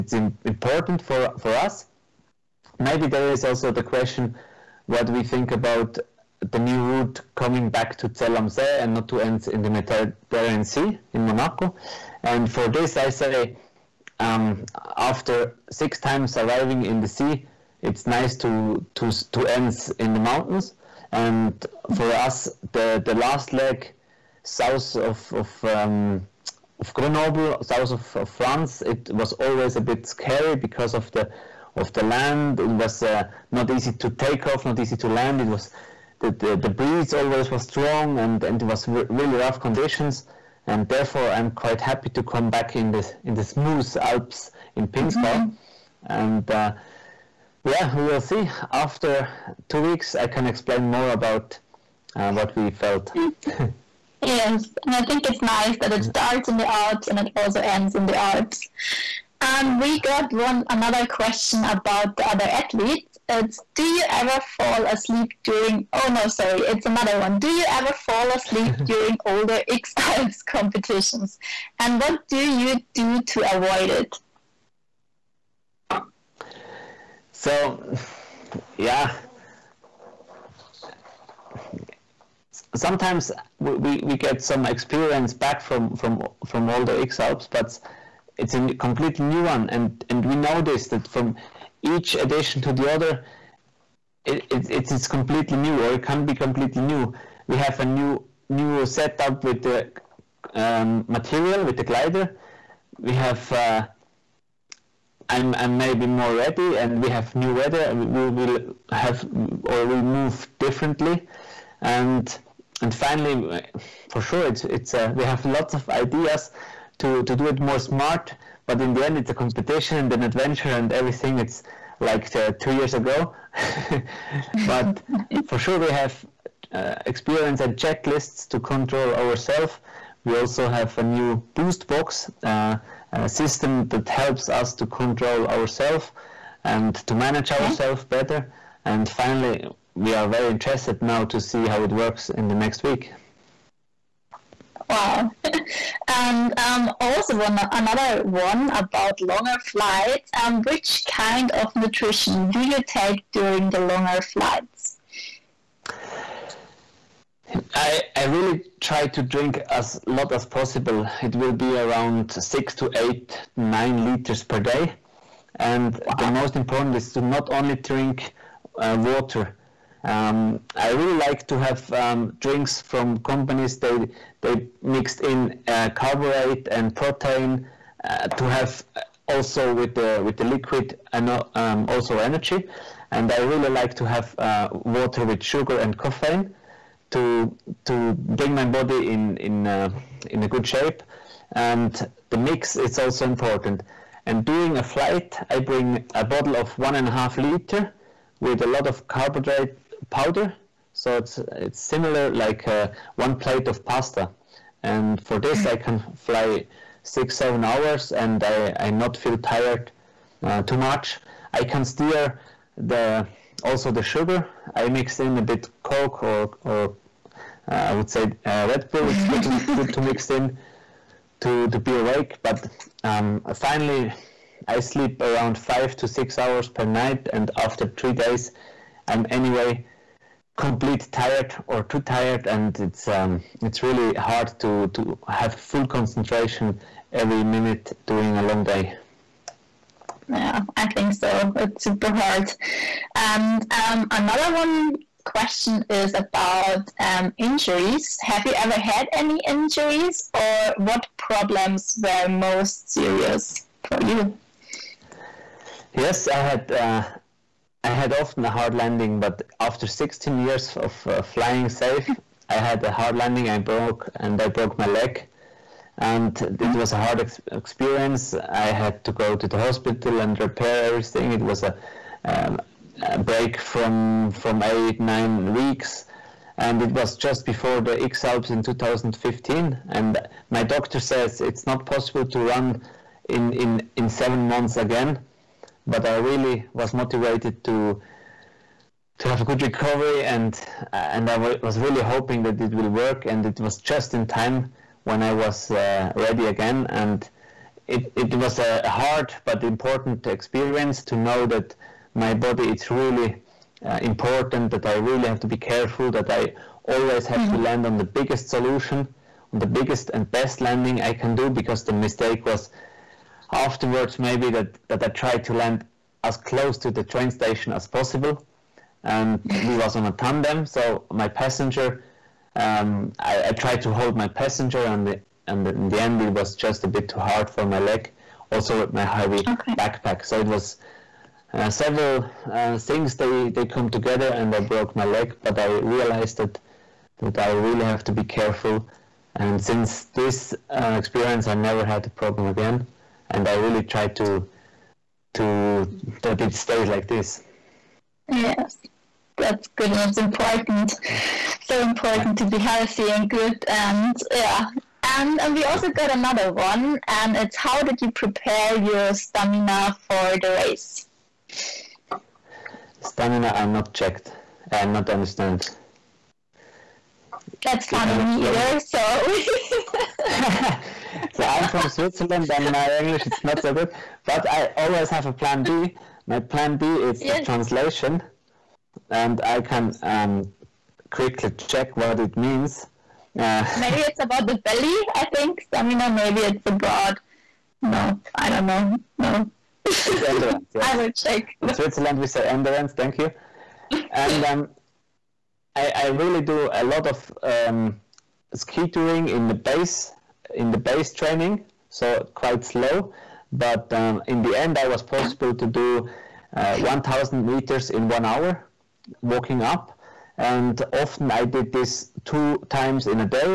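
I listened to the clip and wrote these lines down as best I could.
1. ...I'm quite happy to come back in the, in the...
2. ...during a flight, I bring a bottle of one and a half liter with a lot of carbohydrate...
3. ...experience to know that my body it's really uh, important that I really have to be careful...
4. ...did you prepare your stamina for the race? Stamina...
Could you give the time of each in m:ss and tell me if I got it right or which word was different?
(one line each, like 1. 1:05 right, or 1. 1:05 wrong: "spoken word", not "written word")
1. 0:41 right
2. 3:14 right
3. 5:00 right
4. 5:57 right.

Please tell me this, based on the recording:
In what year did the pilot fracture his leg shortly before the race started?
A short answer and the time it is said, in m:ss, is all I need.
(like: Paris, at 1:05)
2015, at 4:38.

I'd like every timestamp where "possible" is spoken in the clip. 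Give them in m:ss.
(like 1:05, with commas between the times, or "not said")
2:40, 4:41, 5:17, 6:45.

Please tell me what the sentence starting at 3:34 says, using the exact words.
I mix in a bit Coke or or uh, I would say uh, Red Bull.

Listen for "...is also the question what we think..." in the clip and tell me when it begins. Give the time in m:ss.
0:03.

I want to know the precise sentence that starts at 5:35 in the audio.
But I realized that that I really have to be careful.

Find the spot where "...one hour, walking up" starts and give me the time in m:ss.
6:48.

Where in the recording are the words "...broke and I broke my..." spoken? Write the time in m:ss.
4:23.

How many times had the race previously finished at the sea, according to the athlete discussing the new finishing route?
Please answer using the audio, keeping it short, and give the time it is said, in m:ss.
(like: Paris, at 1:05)
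6, at 0:15.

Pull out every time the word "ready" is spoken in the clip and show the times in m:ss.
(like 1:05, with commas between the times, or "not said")
1:46, 4:56.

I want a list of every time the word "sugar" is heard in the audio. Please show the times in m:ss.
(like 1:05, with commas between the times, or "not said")
3:05, 3:34.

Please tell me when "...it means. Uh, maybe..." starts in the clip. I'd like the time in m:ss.
6:22.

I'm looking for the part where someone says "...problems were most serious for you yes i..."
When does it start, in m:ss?
4:11.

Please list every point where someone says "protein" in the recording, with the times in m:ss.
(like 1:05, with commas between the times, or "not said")
2:56.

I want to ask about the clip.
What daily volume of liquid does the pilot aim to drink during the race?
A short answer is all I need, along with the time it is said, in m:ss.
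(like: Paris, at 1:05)
6 to 9 liters, at 2:42.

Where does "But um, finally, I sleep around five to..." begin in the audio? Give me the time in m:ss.
3:42.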